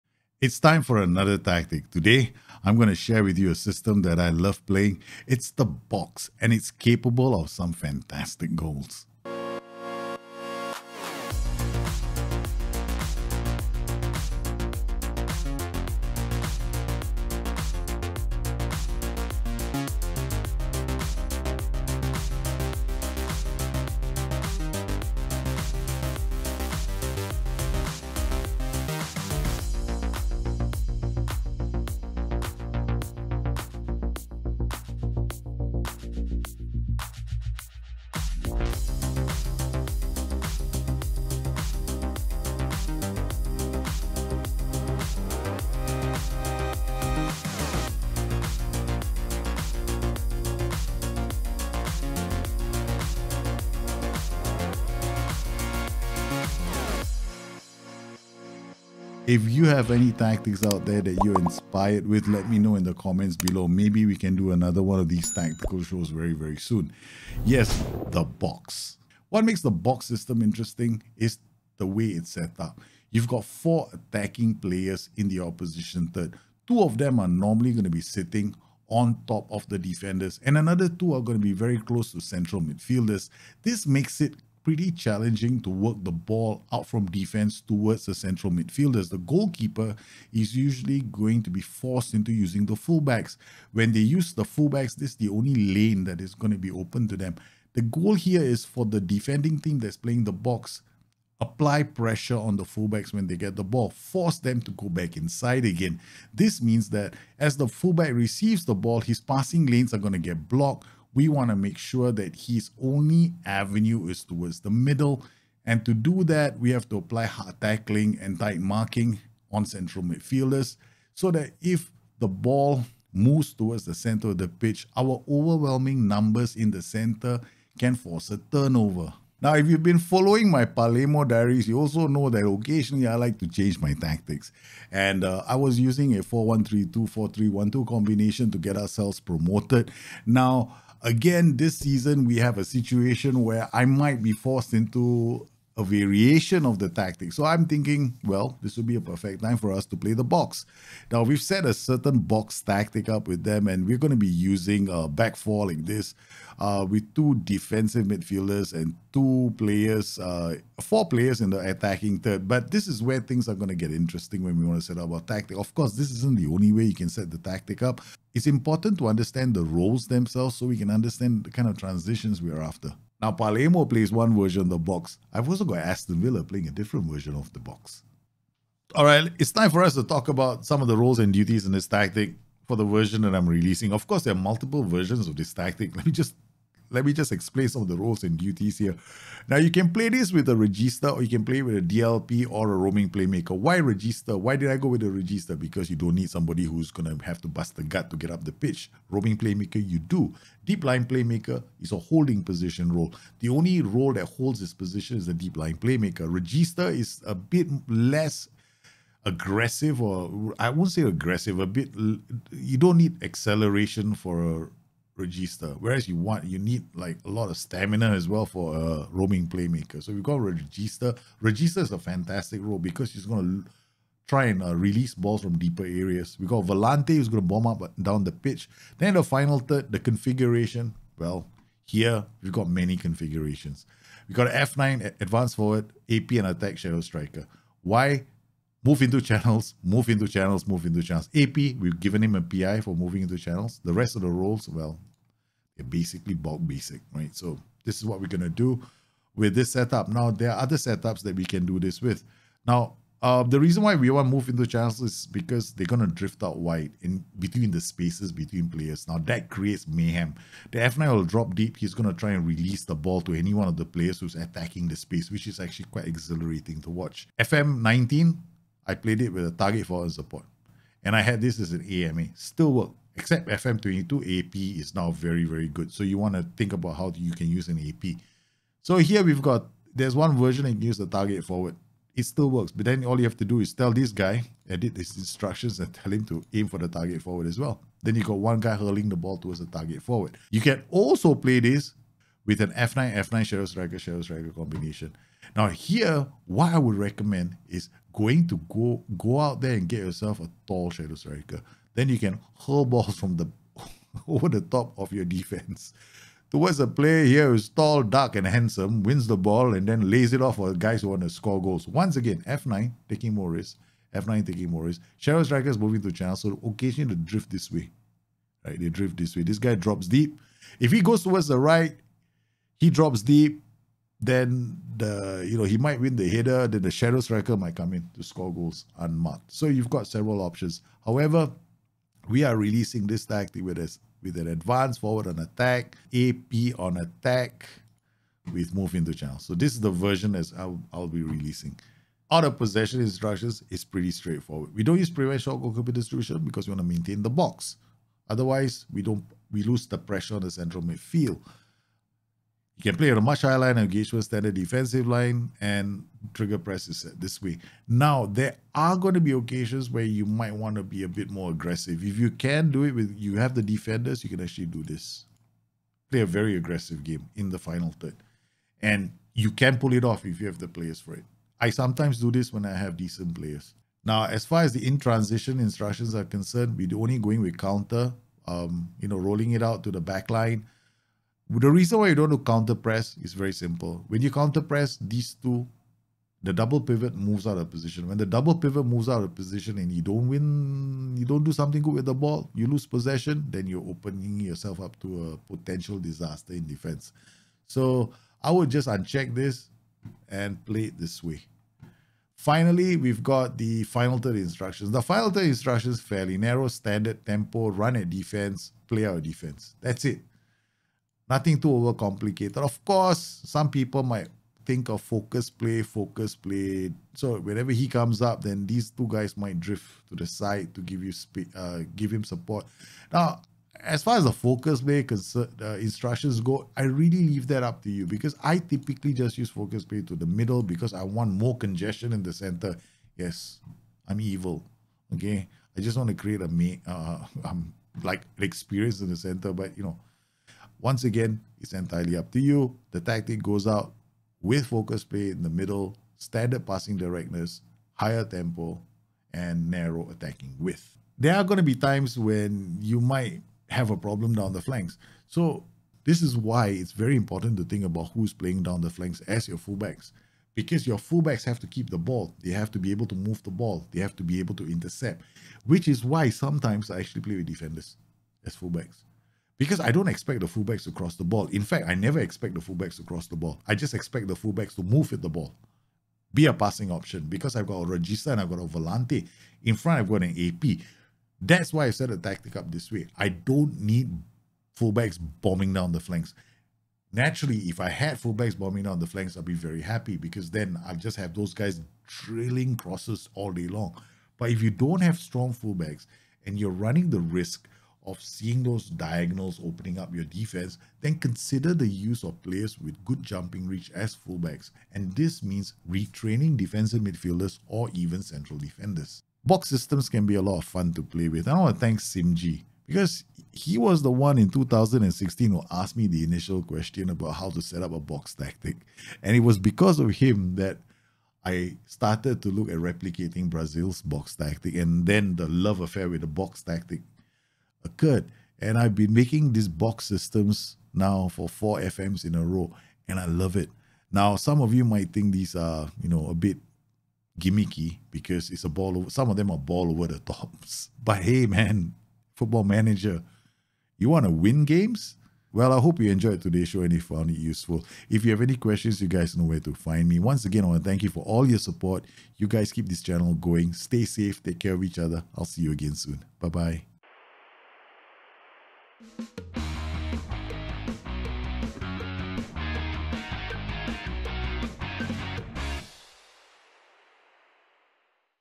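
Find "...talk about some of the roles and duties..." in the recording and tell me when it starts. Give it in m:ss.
3:00.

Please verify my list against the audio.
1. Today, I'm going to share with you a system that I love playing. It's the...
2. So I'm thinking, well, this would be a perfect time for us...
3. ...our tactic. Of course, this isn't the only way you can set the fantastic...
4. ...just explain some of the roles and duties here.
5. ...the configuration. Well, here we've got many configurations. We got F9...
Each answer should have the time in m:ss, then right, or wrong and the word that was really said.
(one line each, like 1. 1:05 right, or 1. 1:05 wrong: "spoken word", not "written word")
1. 0:01 right
2. 2:27 right
3. 2:45 wrong: "tactic", not "fantastic"
4. 3:07 right
5. 3:49 right.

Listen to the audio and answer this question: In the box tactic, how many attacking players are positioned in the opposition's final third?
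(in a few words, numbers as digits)
4.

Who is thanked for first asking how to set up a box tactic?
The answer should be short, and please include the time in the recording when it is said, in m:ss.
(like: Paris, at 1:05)
Simji, at 8:31.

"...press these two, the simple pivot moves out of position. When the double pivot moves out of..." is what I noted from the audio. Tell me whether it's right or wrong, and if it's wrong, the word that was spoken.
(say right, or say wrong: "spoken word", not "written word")
wrong: "double", not "simple".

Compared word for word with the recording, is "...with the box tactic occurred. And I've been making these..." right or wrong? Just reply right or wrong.
right.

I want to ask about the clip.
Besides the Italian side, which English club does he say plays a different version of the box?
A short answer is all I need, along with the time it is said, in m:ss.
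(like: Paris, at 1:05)
Aston Villa, at 2:55.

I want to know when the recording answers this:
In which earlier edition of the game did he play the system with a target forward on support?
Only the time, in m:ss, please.
4:27.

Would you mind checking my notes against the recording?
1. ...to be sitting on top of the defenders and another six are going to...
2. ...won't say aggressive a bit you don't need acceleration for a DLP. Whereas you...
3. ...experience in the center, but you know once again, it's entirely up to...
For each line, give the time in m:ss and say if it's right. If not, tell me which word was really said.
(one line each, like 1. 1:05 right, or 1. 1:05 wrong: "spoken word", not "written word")
1. 1:17 wrong: "two", not "six"
2. 3:30 wrong: "Regista", not "DLP"
3. 7:18 right.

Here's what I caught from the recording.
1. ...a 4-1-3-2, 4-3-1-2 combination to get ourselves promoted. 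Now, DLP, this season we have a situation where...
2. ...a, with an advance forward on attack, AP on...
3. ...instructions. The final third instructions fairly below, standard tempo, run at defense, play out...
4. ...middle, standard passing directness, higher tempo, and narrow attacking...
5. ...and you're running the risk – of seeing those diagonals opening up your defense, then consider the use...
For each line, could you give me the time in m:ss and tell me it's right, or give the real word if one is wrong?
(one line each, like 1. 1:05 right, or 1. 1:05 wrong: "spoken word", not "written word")
1. 2:16 wrong: "Again", not "DLP"
2. 5:33 right
3. 6:44 wrong: "narrow", not "below"
4. 7:25 right
5. 8:16 right.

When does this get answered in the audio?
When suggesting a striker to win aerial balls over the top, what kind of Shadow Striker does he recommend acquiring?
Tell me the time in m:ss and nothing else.
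5:00.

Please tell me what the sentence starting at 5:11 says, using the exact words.
Once again, F9 taking more risks.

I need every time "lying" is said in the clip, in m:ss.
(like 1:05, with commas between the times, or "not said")
3:20, 3:25.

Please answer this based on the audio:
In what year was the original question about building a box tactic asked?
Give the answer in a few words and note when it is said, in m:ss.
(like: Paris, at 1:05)
2016, at 8:34.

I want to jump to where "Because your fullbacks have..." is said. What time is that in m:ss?
7:40.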